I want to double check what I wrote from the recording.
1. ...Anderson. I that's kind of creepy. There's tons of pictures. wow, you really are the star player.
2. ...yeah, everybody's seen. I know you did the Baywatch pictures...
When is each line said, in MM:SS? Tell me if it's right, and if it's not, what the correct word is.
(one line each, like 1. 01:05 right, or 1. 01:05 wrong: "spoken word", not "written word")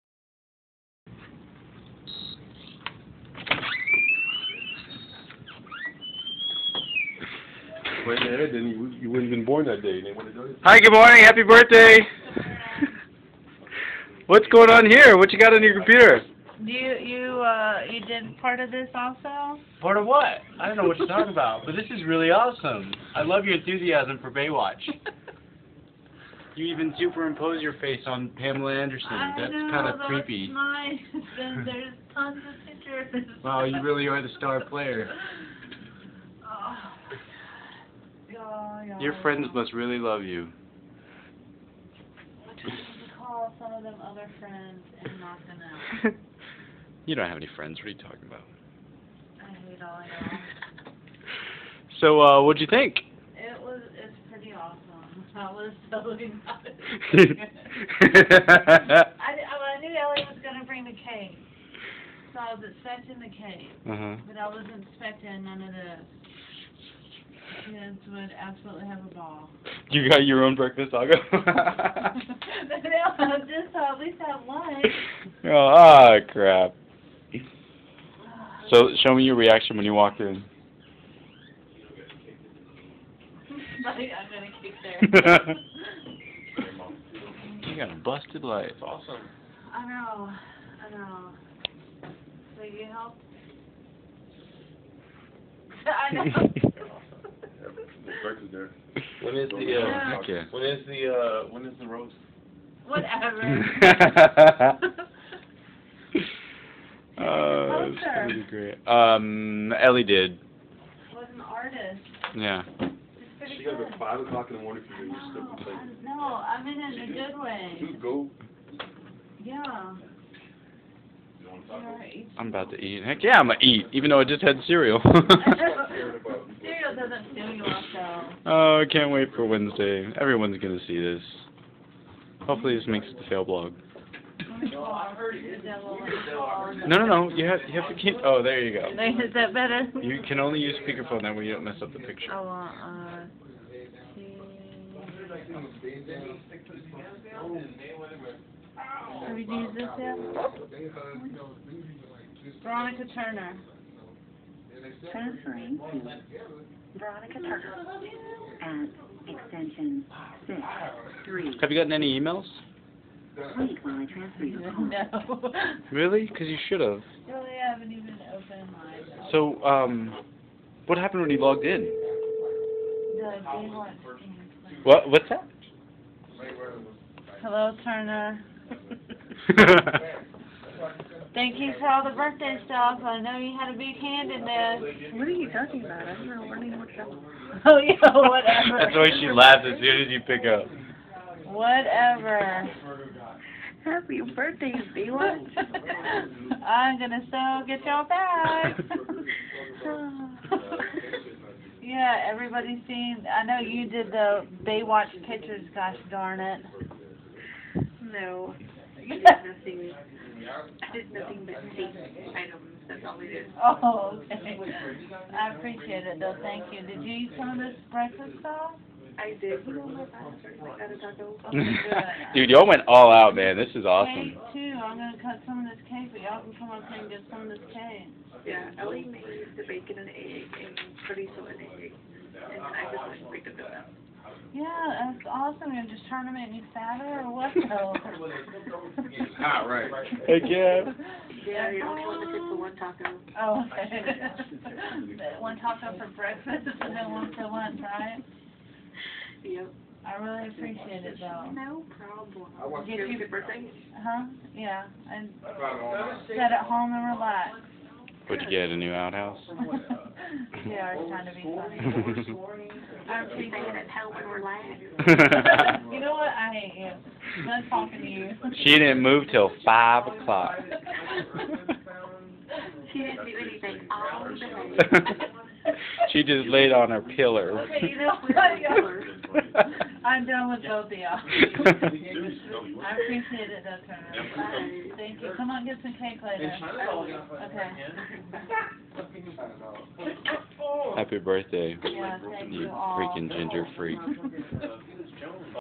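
1. 00:28 right
2. 03:21 right.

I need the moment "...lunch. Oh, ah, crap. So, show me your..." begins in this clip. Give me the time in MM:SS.
01:14.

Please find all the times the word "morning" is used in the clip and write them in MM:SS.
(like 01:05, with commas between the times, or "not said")
00:10, 01:54.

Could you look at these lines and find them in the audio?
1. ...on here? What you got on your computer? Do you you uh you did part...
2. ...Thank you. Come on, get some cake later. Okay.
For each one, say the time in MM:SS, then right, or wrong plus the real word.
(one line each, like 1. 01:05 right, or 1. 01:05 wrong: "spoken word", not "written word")
1. 00:14 right
2. 04:44 right.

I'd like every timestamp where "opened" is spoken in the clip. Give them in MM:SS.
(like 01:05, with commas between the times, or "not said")
02:48.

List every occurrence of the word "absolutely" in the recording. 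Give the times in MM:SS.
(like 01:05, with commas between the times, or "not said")
01:08.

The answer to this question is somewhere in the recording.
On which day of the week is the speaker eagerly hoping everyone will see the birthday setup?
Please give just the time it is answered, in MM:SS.
02:09.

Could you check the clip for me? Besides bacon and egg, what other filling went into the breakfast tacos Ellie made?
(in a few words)
chorizo.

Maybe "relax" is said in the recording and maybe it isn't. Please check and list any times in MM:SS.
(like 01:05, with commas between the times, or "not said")
04:17, 04:24.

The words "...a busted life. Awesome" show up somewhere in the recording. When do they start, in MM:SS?
01:27.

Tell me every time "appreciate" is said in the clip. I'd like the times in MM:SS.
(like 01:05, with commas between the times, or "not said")
03:35, 04:10, 04:41.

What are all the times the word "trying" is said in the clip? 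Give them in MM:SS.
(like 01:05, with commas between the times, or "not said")
03:56, 04:21.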